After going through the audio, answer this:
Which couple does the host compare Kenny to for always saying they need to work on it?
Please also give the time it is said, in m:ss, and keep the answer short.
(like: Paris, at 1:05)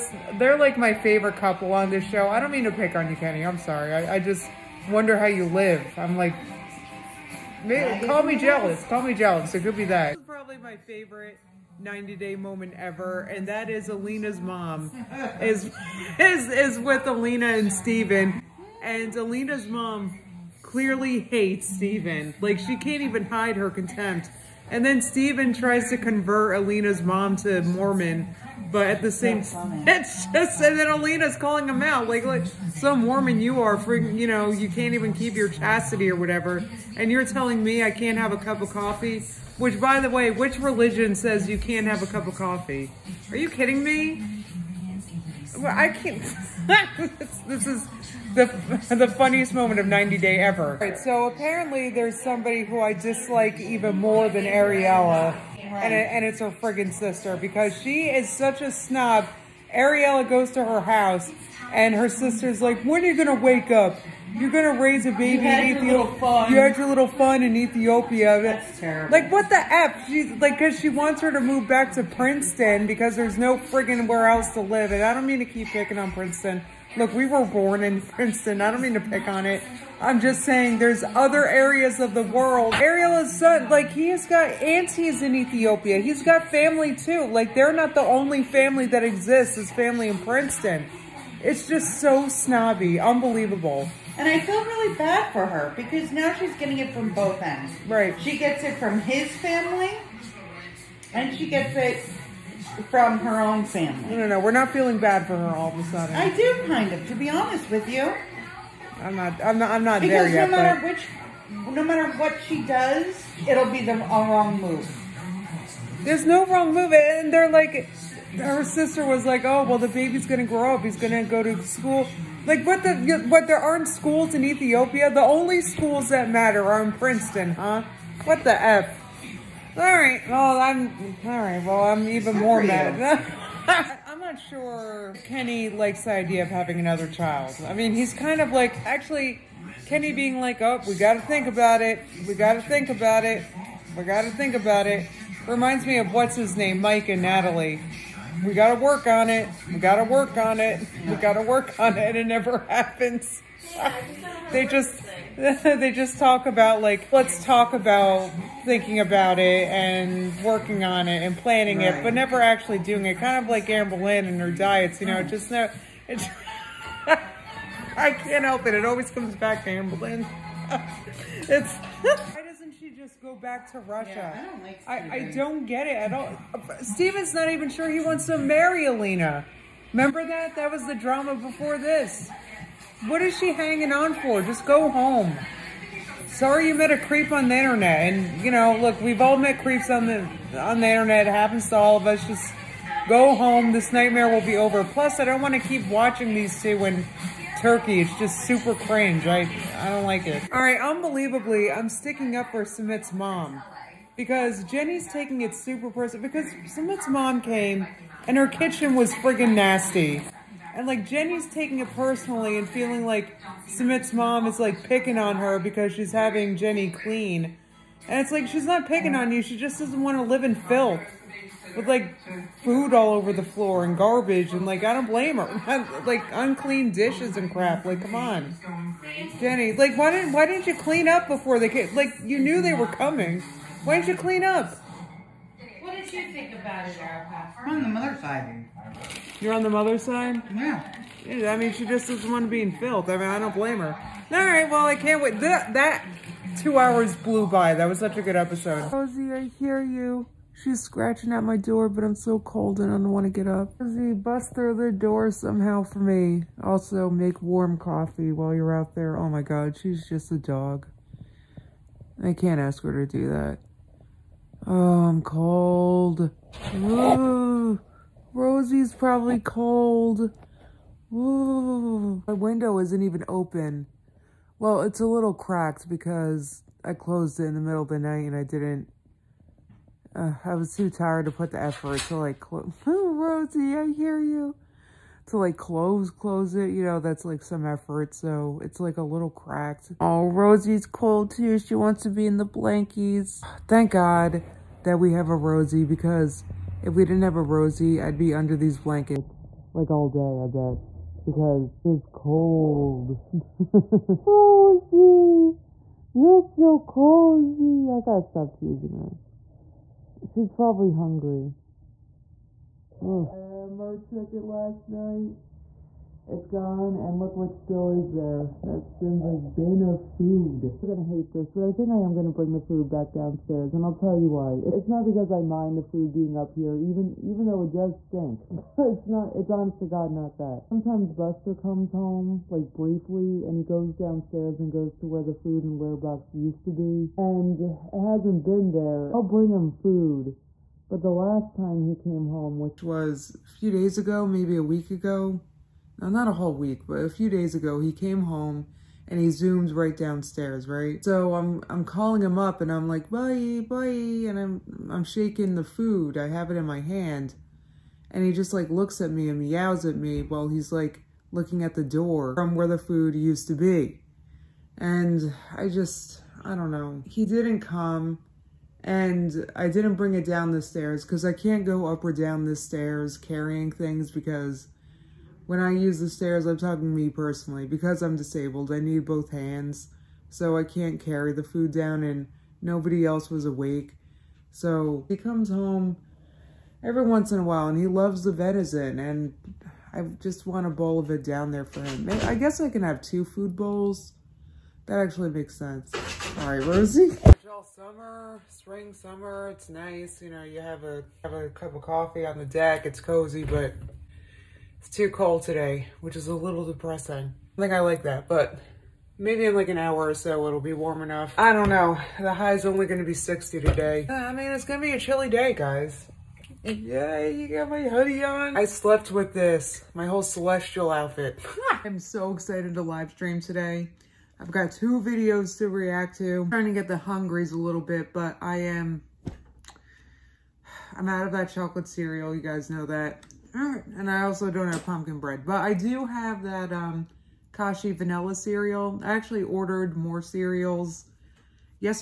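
Mike and Natalie, at 2:26.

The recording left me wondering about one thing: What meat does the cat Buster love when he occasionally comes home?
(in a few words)
venison.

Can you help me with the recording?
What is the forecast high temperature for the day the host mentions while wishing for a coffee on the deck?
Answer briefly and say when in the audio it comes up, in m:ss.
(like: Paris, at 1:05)
60, at 6:53.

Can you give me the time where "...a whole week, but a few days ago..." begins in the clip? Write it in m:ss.
5:46.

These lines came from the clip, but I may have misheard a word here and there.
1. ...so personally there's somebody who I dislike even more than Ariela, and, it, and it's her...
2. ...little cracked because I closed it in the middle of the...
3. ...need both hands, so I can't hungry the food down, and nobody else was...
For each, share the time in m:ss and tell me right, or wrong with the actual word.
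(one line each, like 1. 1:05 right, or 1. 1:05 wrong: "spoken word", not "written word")
1. 0:50 wrong: "apparently", not "personally"
2. 4:35 right
3. 6:18 wrong: "carry", not "hungry".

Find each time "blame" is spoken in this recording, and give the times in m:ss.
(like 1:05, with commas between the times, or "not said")
3:45, 4:03.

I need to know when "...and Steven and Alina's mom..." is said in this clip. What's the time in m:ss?
0:17.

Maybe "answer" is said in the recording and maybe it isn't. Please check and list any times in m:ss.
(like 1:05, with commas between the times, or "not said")
not said.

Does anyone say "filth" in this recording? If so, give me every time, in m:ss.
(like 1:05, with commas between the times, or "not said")
3:40, 4:02.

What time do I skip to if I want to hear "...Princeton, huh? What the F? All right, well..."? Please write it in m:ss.
2:06.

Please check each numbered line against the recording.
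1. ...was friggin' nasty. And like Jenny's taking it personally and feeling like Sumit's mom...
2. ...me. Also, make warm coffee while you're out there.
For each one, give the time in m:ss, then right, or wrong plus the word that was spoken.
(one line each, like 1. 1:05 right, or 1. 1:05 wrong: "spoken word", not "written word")
1. 3:28 right
2. 4:15 right.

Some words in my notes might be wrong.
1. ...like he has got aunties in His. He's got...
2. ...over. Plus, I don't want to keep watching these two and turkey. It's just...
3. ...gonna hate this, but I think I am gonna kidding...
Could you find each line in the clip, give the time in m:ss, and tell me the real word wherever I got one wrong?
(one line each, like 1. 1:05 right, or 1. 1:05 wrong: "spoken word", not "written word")
1. 1:23 wrong: "Ethiopia", not "His"
2. 3:14 right
3. 5:20 wrong: "bring", not "kidding".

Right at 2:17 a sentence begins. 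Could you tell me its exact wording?
I mean, he's kind of like actually Kenny being like, "Oh, we got to think about it.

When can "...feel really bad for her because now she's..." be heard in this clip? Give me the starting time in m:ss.
1:34.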